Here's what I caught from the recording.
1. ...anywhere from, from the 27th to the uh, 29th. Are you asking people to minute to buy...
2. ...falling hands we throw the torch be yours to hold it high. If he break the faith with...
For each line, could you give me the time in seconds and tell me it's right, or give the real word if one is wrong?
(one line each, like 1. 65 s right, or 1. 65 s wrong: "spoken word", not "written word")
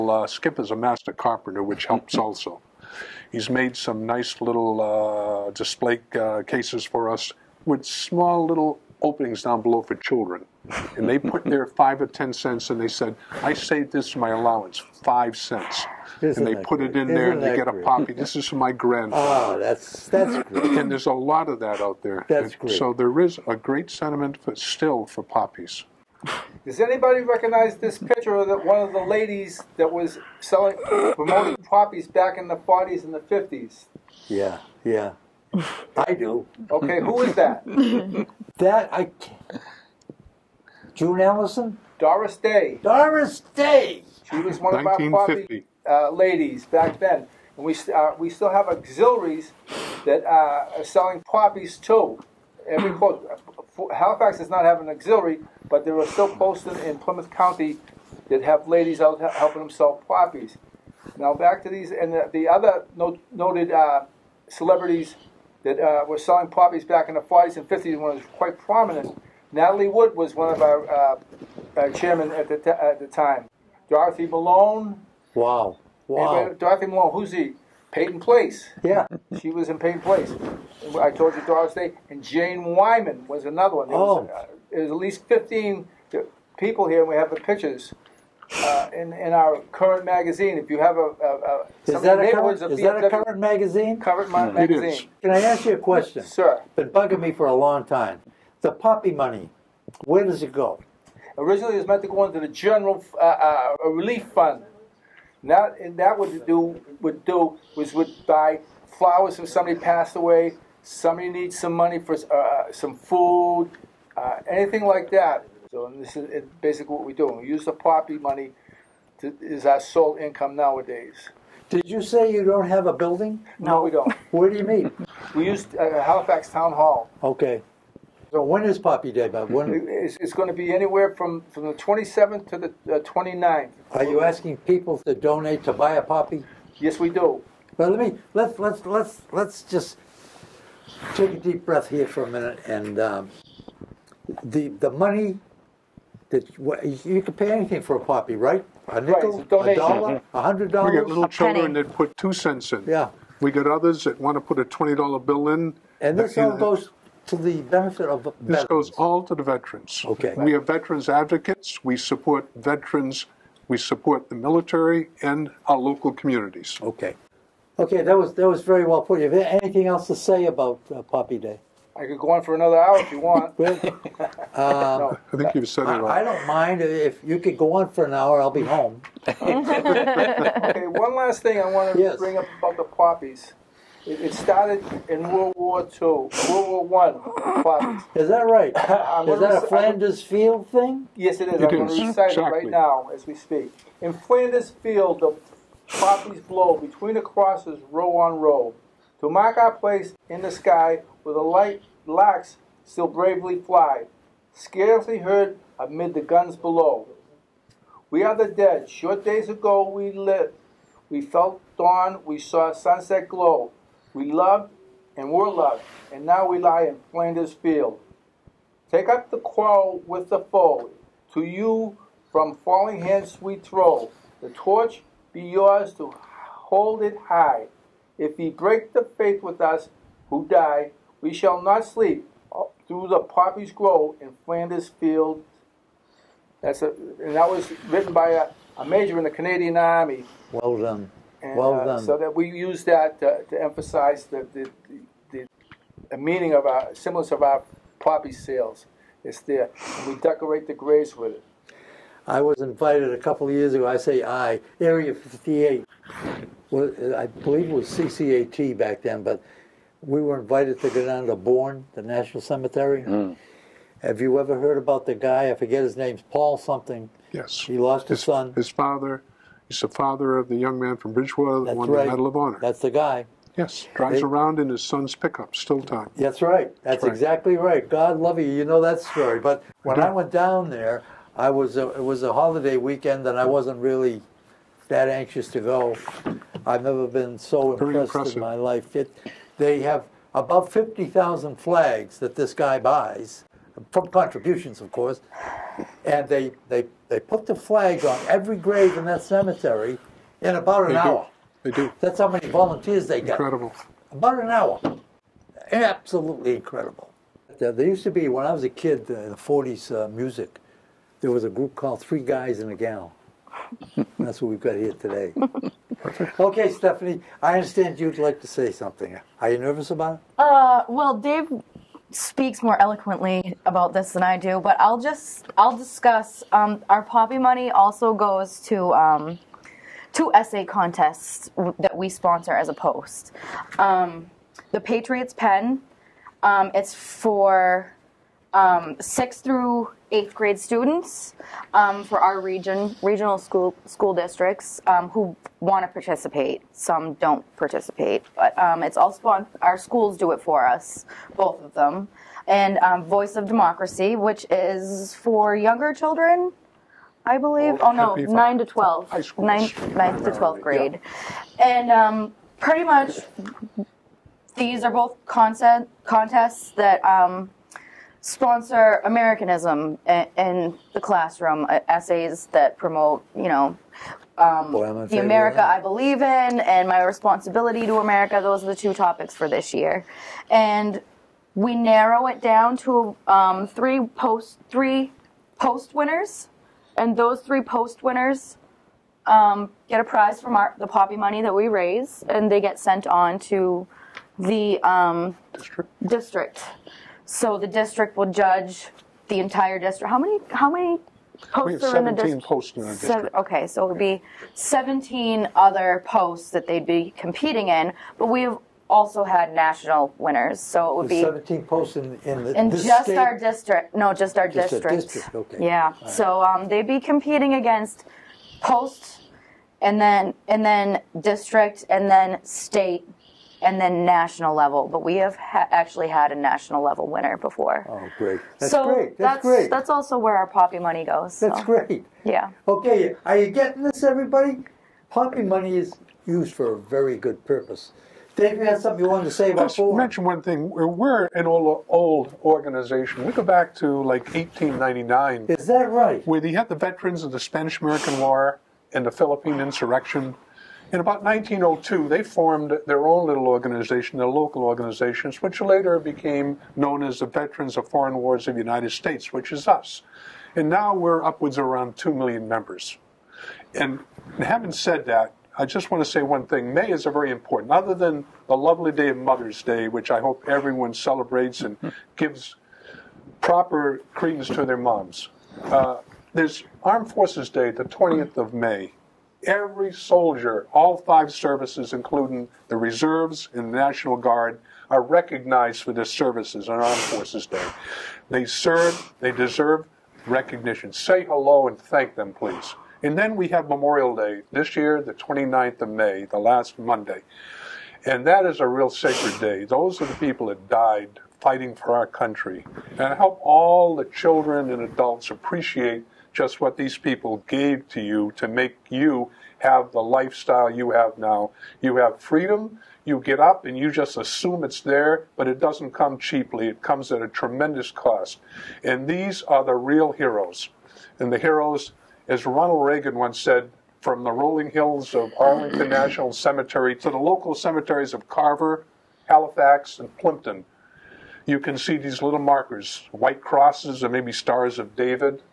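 1. 130 s wrong: "donate", not "minute"
2. 222 s right.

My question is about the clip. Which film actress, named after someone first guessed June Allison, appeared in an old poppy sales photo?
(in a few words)
Doris Day.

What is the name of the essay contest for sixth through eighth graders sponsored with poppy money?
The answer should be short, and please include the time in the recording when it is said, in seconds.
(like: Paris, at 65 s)
Patriots Pen, at 334 s.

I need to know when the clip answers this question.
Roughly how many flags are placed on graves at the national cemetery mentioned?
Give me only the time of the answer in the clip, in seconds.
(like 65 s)
290 s.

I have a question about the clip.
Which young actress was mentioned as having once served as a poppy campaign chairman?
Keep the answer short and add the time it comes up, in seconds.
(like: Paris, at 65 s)
Natalie Wood, at 69 s.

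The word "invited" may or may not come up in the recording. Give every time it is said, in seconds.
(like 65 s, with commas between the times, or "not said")
252 s, 260 s.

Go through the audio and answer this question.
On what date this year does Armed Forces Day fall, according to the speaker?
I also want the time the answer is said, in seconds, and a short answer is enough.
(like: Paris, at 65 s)
May 20, at 477 s.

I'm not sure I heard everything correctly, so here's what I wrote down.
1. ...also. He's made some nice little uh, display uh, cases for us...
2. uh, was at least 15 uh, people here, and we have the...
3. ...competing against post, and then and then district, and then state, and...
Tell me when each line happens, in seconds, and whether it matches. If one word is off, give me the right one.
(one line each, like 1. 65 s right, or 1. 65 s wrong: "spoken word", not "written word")
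1. 2 s right
2. 84 s right
3. 416 s right.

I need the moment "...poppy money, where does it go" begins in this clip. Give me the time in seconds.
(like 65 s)
98 s.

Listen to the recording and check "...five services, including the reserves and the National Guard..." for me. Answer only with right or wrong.
right.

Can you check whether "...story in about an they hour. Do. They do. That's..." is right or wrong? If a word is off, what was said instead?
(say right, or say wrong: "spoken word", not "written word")
wrong: "cemetery", not "story".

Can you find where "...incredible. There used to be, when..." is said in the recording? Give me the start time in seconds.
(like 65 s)
306 s.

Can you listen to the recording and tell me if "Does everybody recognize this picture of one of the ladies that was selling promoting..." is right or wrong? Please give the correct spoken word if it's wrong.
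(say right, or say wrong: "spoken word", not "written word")
wrong: "anybody", not "everybody".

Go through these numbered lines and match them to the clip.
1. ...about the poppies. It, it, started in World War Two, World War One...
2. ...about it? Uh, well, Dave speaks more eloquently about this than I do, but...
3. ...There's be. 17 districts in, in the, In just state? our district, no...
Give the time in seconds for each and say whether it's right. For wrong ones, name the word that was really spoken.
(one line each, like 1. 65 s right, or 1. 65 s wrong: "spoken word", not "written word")
1. 182 s right
2. 319 s right
3. 411 s wrong: "posts", not "districts".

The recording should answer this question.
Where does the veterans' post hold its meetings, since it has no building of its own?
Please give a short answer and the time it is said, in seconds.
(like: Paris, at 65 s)
Halifax Town Hall, at 126 s.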